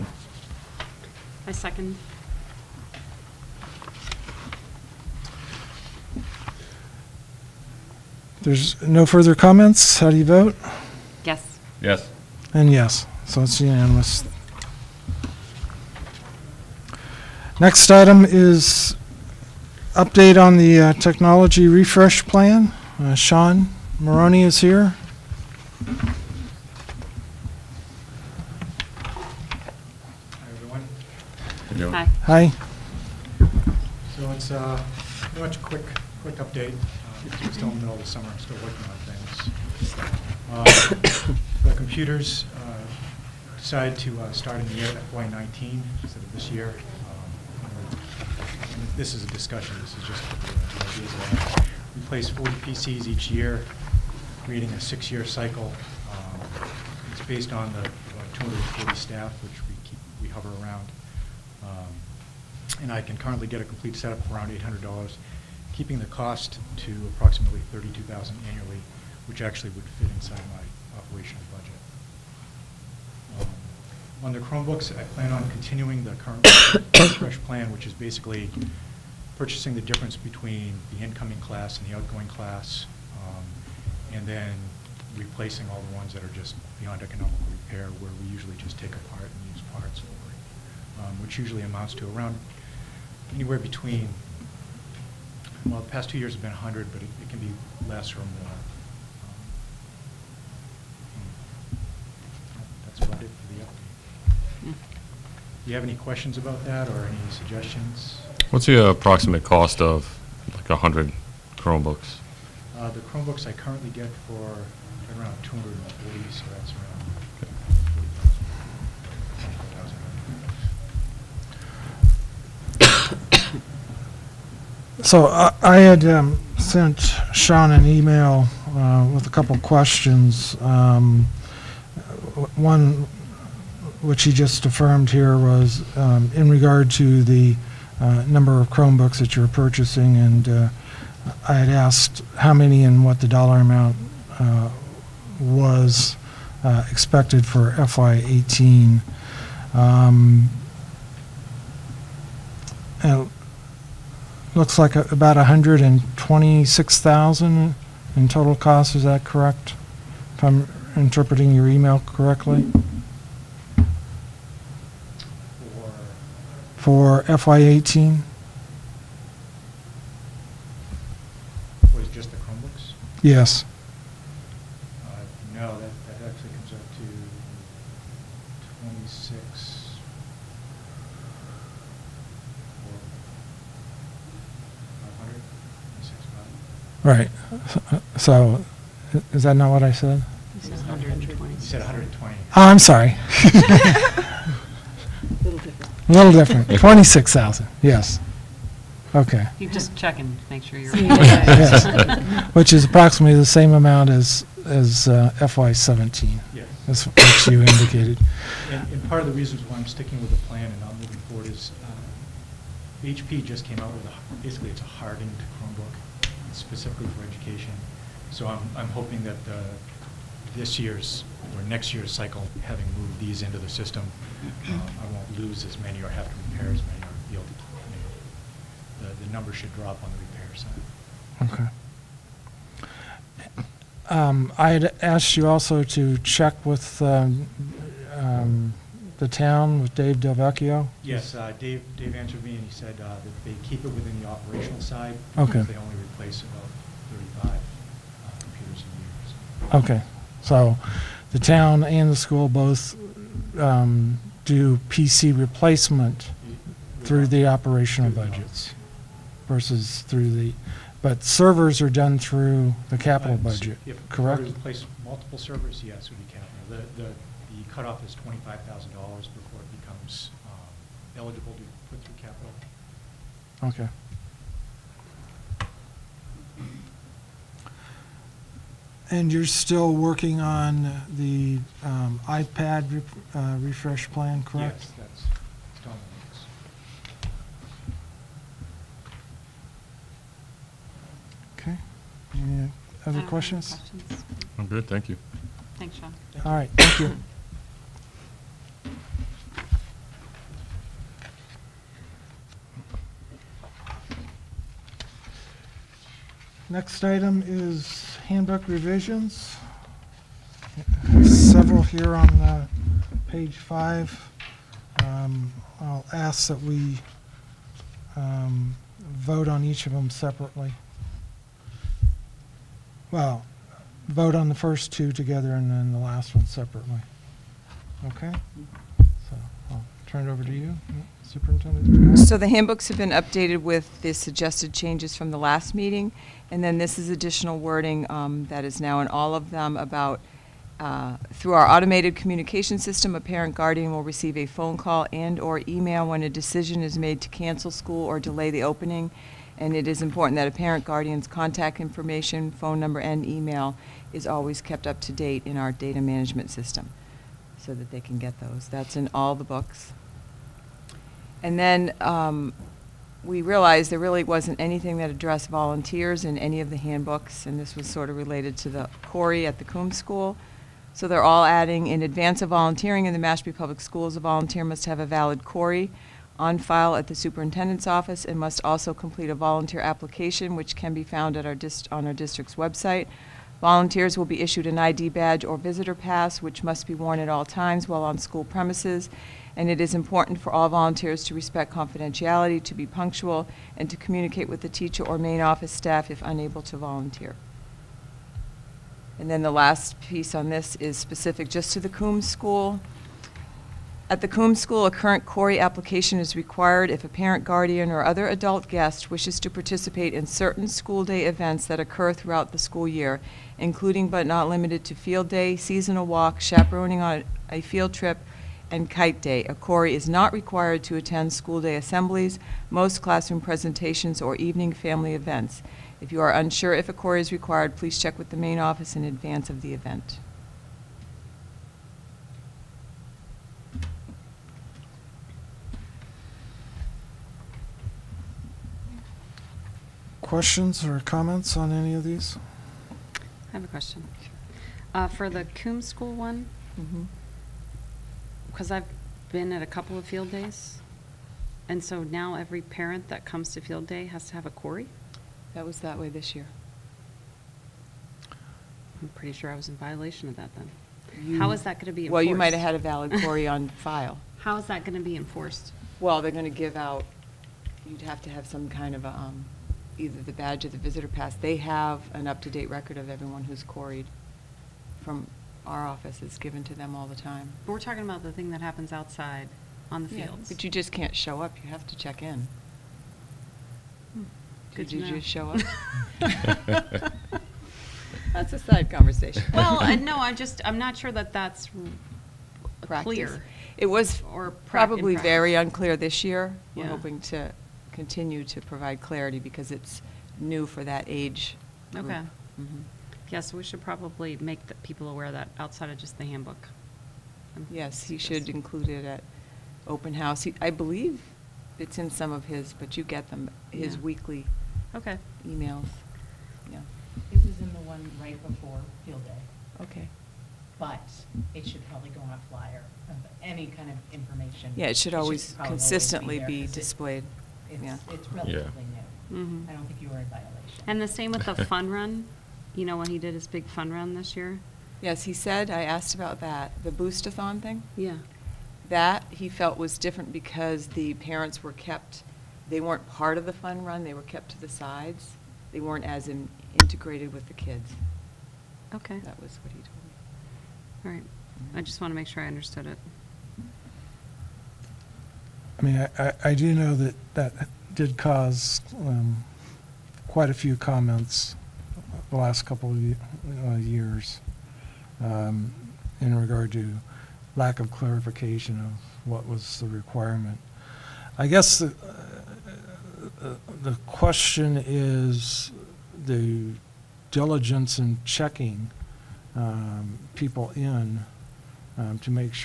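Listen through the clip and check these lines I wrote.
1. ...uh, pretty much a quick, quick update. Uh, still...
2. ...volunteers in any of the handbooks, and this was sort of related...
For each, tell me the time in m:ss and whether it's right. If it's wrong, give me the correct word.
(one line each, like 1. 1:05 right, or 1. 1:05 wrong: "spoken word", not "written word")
1. 0:34 right
2. 6:05 right.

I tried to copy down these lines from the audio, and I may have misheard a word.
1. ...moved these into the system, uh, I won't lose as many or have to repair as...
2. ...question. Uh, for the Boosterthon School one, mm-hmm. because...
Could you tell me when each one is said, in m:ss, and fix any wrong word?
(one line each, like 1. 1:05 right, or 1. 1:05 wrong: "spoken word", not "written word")
1. 3:42 right
2. 7:23 wrong: "Coombs", not "Boosterthon".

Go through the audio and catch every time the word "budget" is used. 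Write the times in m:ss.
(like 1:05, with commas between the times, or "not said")
1:11, 4:18, 4:23.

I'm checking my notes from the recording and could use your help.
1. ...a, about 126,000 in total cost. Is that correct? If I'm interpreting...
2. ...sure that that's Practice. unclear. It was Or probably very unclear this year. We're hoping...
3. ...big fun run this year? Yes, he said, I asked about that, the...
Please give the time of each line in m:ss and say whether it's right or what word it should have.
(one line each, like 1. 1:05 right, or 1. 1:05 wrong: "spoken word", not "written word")
1. 2:34 right
2. 8:10 wrong: "clear", not "unclear"
3. 8:53 right.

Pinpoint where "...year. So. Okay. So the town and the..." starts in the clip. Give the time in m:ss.
4:08.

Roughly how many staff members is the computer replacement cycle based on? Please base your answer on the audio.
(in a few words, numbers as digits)
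240.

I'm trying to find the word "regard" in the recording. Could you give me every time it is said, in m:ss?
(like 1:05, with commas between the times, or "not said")
2:16, 9:26.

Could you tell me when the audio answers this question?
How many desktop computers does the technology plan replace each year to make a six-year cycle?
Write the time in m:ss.
0:52.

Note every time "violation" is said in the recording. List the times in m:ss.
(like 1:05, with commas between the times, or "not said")
7:39, 8:50.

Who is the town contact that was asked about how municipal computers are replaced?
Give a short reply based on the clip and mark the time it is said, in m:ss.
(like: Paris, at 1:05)
Dave Delvecchio, at 3:59.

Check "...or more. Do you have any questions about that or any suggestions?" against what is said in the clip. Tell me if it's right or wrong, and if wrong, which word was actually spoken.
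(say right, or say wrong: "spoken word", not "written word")
right.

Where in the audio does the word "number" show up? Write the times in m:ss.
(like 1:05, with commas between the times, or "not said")
2:18, 3:49, 5:52.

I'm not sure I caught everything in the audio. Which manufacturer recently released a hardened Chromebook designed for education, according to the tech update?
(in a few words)
HP.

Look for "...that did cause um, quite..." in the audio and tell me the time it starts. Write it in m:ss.
9:17.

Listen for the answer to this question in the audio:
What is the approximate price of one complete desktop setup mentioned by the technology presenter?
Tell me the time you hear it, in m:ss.
1:04.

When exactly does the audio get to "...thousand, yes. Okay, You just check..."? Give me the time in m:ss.
3:17.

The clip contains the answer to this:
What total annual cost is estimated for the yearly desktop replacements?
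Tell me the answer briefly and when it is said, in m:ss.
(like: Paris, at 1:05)
32000, at 1:07.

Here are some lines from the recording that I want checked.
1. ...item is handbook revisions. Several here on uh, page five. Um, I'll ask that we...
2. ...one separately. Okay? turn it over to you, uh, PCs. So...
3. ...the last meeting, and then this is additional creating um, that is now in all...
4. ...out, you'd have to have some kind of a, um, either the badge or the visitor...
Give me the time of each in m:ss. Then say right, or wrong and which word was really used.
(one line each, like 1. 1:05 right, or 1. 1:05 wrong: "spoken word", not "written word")
1. 5:07 right
2. 5:26 wrong: "Superintendent", not "PCs"
3. 5:35 wrong: "wording", not "creating"
4. 7:46 right.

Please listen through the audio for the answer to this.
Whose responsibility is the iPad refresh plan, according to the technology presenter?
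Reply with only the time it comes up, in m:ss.
4:45.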